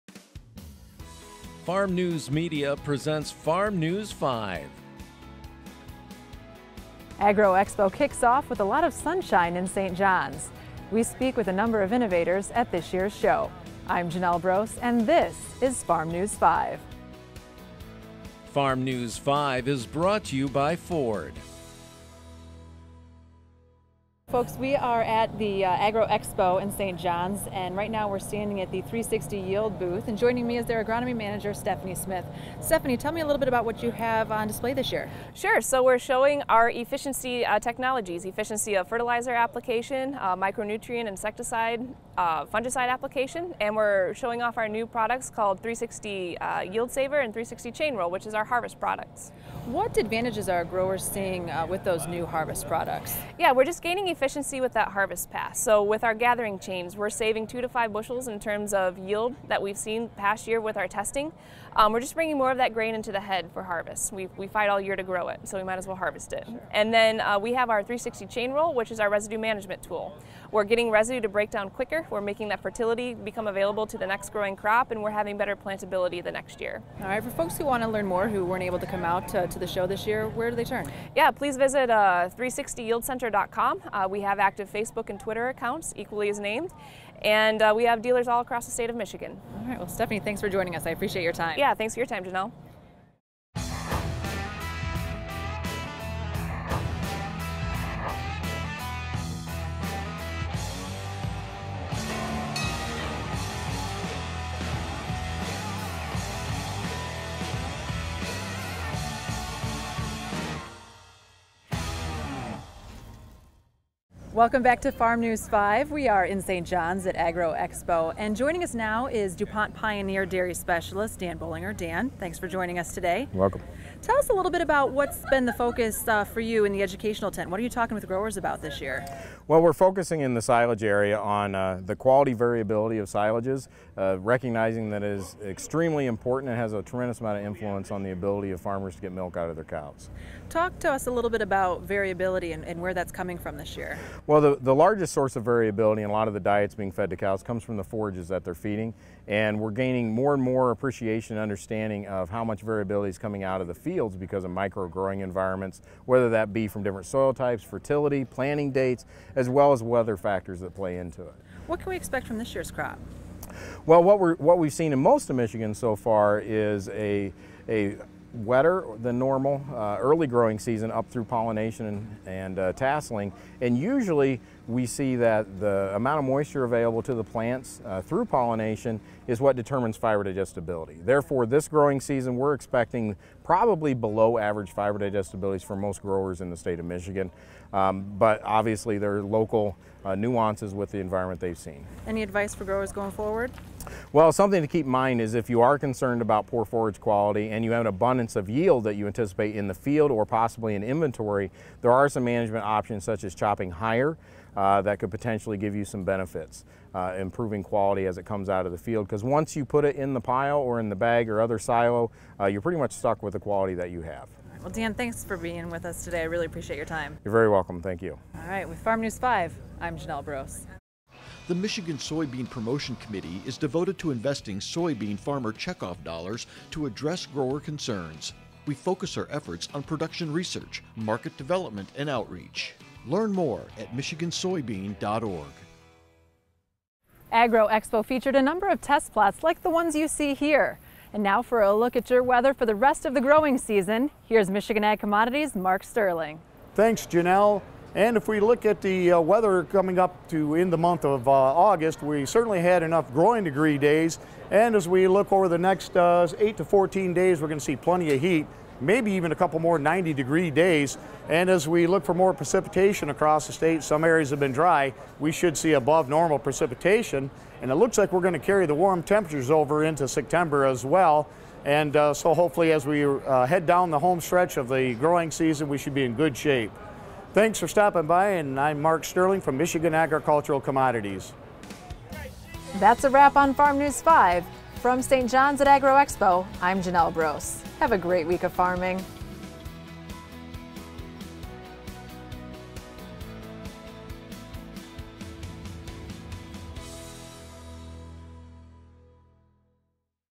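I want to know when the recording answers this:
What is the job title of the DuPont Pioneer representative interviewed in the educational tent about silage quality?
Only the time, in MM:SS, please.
02:00.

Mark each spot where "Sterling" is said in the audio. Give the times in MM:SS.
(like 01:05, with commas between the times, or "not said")
04:05, 04:39.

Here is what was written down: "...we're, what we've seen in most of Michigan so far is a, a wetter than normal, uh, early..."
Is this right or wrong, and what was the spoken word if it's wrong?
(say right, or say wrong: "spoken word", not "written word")
right.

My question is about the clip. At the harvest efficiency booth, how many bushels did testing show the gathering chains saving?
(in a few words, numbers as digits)
2 to 5.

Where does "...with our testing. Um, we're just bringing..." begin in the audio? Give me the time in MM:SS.
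01:00.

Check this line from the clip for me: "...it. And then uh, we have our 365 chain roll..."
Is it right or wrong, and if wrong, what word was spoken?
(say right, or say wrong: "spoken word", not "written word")
wrong: "360", not "365".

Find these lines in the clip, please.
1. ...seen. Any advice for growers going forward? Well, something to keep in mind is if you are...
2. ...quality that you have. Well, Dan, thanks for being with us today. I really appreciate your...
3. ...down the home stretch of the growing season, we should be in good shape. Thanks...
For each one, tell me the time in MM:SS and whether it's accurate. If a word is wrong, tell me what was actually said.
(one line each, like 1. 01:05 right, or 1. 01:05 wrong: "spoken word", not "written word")
1. 03:11 right
2. 03:33 right
3. 04:33 right.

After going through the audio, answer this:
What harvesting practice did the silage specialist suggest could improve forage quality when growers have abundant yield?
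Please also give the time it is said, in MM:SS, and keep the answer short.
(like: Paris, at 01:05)
Chopping higher, at 03:23.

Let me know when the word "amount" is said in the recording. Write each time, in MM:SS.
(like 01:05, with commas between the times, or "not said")
02:17, 02:55.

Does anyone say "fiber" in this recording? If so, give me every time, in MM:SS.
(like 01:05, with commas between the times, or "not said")
02:59, 03:04.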